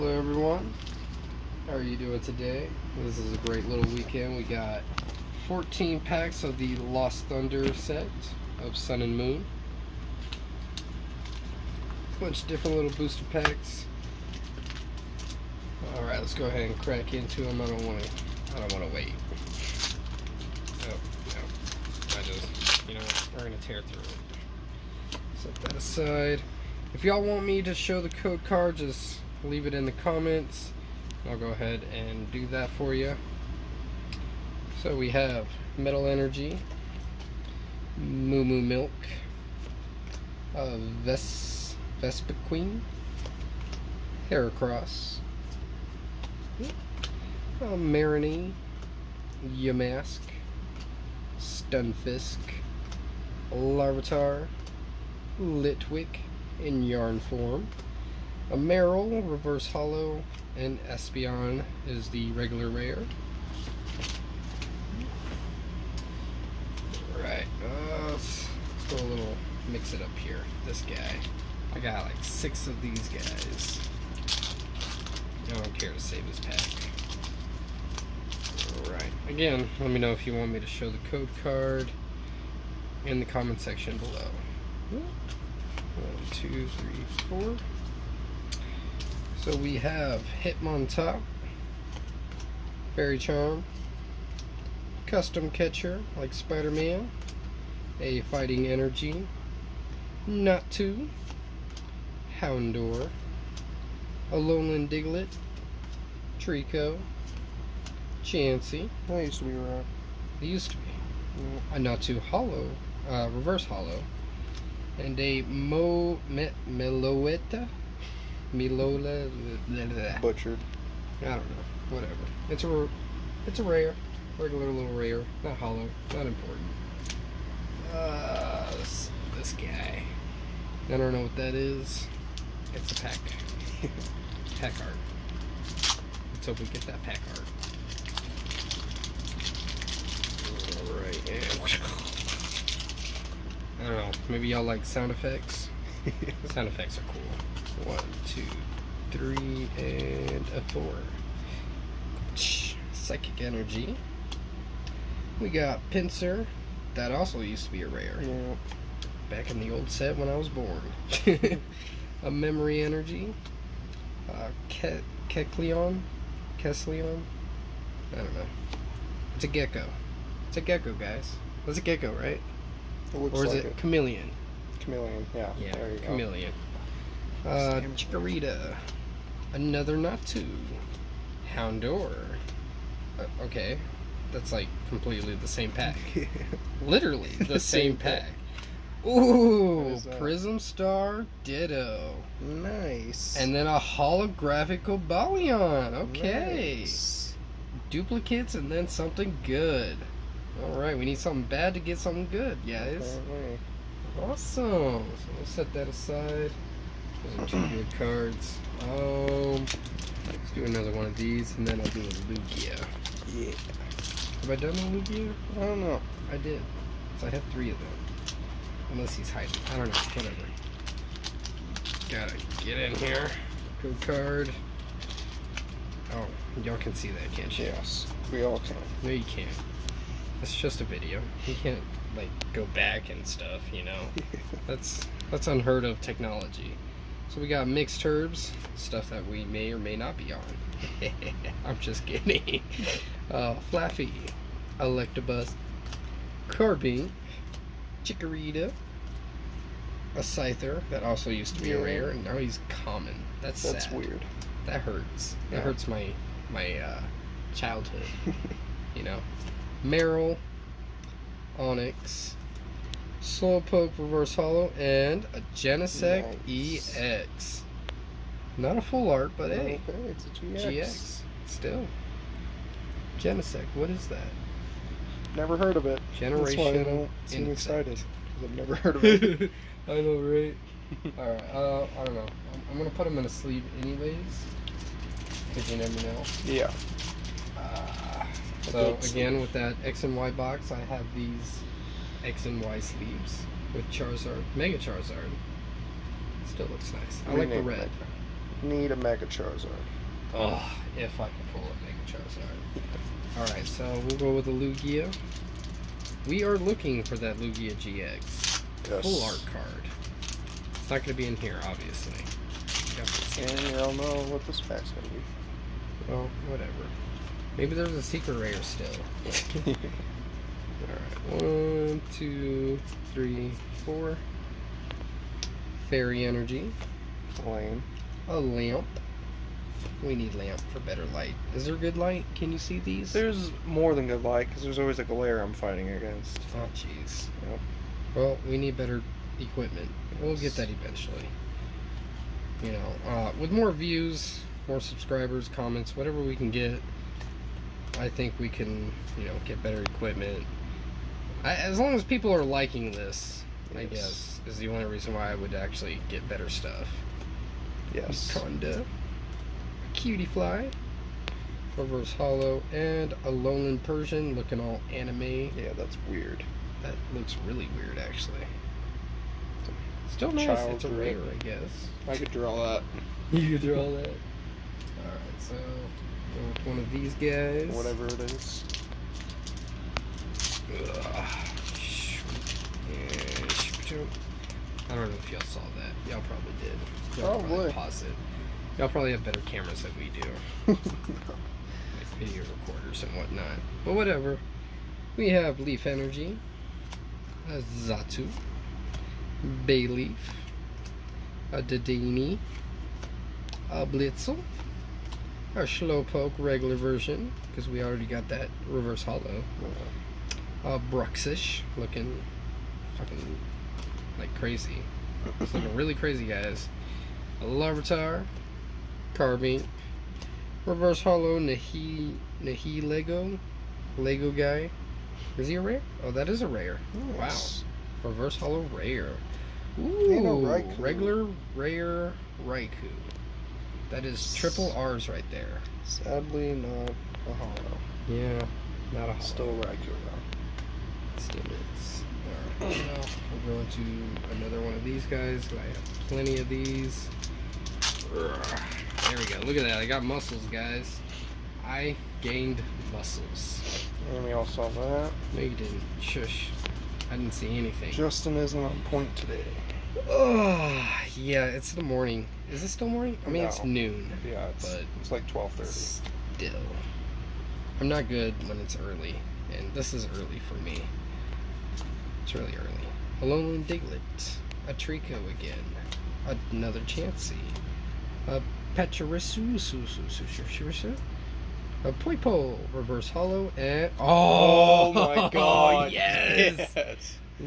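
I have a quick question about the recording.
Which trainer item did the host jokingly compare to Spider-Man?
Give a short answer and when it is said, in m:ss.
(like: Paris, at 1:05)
Custom Catcher, at 1:35.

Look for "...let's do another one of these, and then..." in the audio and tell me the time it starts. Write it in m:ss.
3:30.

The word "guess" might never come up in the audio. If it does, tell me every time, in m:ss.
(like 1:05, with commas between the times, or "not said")
5:53, 6:11.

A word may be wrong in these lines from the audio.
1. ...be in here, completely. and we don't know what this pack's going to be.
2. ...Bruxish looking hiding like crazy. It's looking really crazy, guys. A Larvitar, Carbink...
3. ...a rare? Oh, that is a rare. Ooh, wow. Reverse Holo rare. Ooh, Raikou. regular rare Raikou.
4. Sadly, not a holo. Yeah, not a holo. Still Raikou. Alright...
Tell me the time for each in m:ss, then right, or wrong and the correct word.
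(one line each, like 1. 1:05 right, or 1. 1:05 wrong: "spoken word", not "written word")
1. 5:11 wrong: "obviously", not "completely"
2. 6:50 wrong: "fucking", not "hiding"
3. 7:05 right
4. 7:15 right.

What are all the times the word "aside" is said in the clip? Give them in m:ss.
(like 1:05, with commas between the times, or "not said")
0:25, 3:25.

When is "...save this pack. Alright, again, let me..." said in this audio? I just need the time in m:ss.
1:16.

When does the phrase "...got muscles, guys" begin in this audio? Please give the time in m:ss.
7:29.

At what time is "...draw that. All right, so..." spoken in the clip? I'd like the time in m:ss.
6:13.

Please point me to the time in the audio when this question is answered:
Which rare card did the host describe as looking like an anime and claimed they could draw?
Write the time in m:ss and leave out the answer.
6:03.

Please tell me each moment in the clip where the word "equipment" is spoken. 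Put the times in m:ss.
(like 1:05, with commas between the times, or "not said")
5:39, 5:49.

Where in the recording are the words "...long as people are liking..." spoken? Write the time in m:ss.
5:51.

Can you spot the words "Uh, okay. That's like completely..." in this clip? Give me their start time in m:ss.
3:03.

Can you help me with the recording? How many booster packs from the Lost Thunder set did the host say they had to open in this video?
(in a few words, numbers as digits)
14.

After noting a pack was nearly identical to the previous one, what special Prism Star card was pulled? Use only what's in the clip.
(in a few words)
Ditto.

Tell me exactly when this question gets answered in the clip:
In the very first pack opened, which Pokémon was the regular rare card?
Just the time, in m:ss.
1:00.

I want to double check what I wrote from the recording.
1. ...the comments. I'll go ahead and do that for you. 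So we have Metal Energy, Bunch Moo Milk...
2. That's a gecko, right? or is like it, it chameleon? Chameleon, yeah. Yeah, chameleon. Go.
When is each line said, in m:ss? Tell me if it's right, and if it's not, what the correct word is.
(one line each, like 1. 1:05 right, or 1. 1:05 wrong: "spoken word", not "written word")
1. 0:29 wrong: "Moo", not "Bunch"
2. 2:51 right.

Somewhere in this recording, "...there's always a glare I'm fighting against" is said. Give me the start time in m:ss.
5:34.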